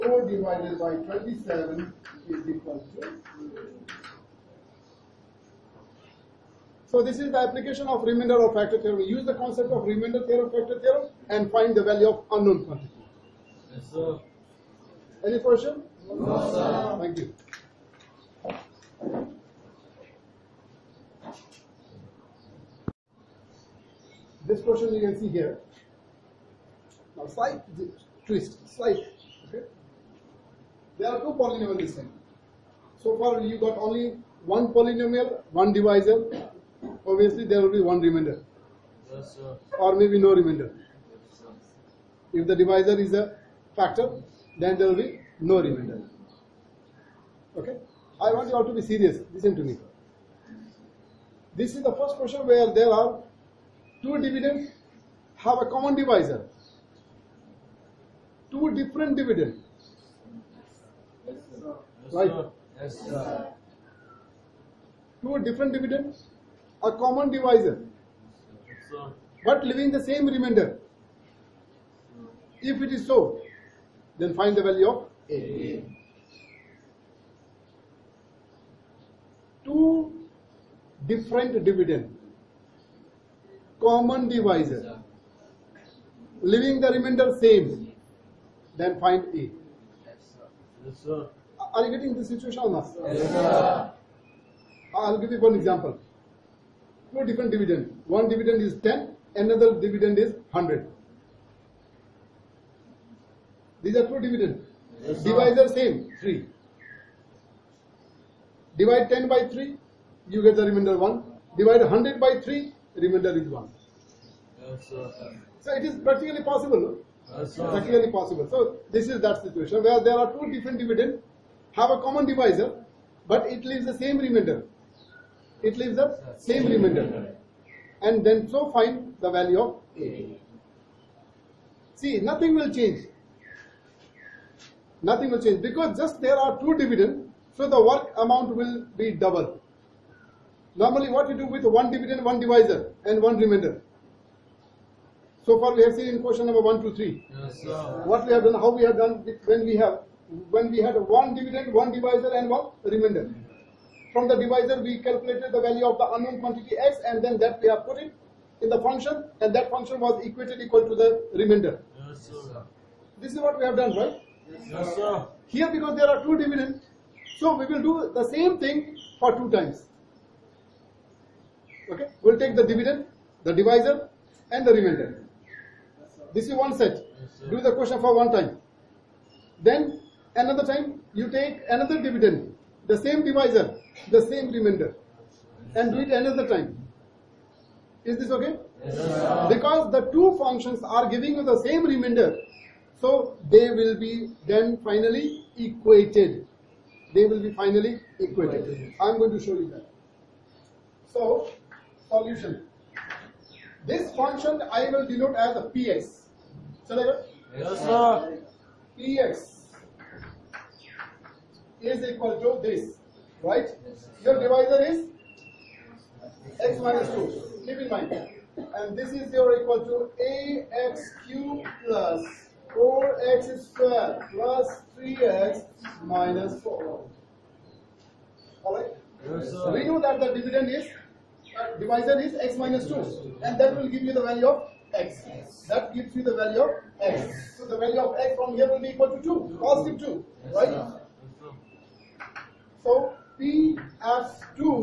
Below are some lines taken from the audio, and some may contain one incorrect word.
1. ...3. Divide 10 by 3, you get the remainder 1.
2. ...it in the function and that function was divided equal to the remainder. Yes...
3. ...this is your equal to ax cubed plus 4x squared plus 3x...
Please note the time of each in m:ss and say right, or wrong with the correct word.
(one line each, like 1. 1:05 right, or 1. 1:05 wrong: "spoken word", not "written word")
1. 1:46 right
2. 2:37 wrong: "equated", not "divided"
3. 3:38 right.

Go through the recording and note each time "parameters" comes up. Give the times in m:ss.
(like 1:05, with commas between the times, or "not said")
not said.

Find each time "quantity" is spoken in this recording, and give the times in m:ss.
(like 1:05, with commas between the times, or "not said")
0:12, 2:36.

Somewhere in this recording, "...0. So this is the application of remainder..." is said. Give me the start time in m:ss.
0:03.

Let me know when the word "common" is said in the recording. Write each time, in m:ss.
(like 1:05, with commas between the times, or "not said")
0:55, 1:06, 1:23, 2:01.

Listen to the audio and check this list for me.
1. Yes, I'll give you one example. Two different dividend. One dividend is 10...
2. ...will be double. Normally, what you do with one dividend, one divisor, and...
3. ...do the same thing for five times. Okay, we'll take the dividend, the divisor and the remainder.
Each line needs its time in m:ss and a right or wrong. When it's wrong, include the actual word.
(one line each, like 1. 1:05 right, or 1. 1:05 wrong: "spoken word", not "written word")
1. 1:33 right
2. 2:18 right
3. 2:47 wrong: "two", not "five".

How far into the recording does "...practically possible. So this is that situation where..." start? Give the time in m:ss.
1:57.